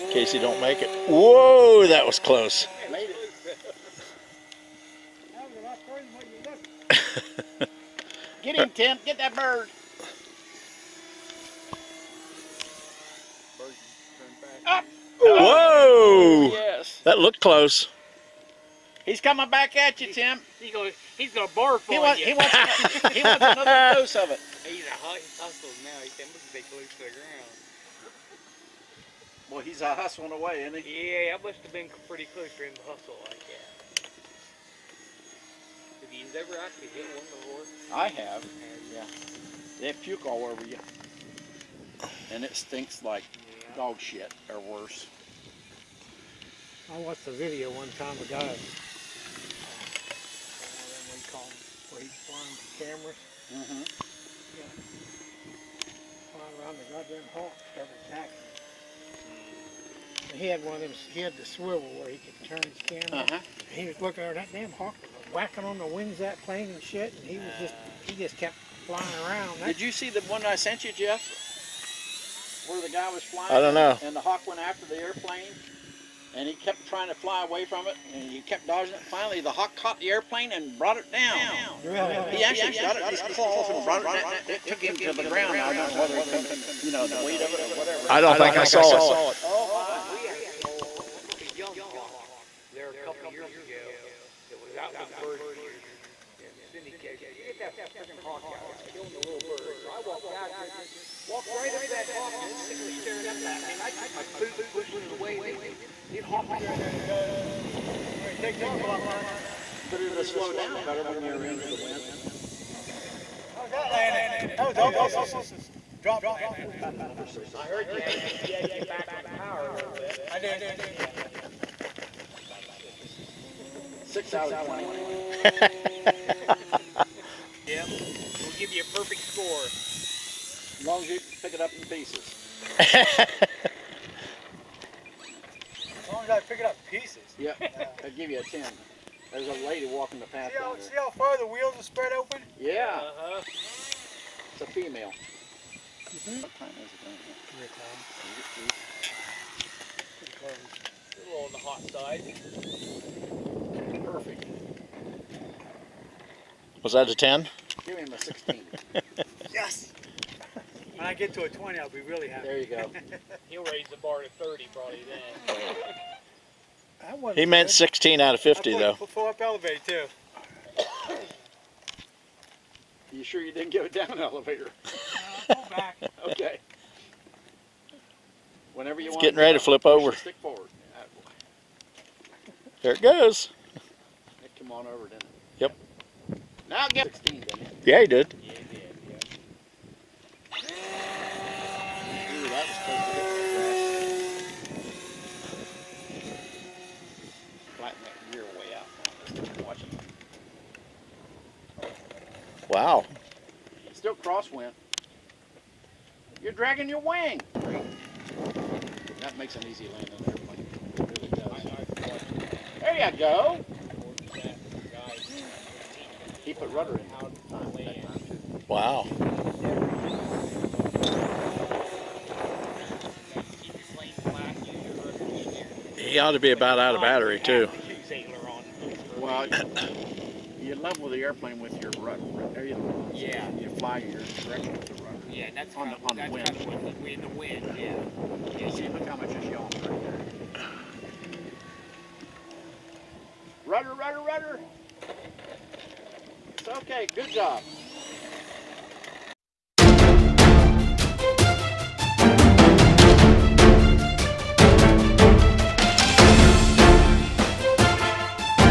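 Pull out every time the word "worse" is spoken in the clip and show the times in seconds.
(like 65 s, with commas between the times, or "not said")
44 s.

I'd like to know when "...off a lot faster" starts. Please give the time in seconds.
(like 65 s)
108 s.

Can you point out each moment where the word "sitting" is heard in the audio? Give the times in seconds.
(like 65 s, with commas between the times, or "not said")
102 s.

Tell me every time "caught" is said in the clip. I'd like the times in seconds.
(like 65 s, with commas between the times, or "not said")
79 s.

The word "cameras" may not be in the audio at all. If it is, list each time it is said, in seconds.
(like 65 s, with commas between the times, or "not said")
52 s, 62 s.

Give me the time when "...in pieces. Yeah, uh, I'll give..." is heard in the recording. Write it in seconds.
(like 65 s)
136 s.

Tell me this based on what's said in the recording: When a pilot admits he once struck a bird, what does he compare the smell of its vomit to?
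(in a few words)
dog shit.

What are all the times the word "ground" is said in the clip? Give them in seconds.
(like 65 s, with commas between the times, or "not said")
27 s, 85 s.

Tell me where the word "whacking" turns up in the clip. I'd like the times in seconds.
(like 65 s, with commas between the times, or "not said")
65 s.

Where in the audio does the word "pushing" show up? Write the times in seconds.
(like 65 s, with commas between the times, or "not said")
104 s.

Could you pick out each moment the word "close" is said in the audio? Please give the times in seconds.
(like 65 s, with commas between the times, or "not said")
2 s, 17 s, 26 s, 32 s.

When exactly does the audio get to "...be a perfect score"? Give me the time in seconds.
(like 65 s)
128 s.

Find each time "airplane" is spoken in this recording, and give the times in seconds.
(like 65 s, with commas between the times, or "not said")
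75 s, 80 s, 231 s.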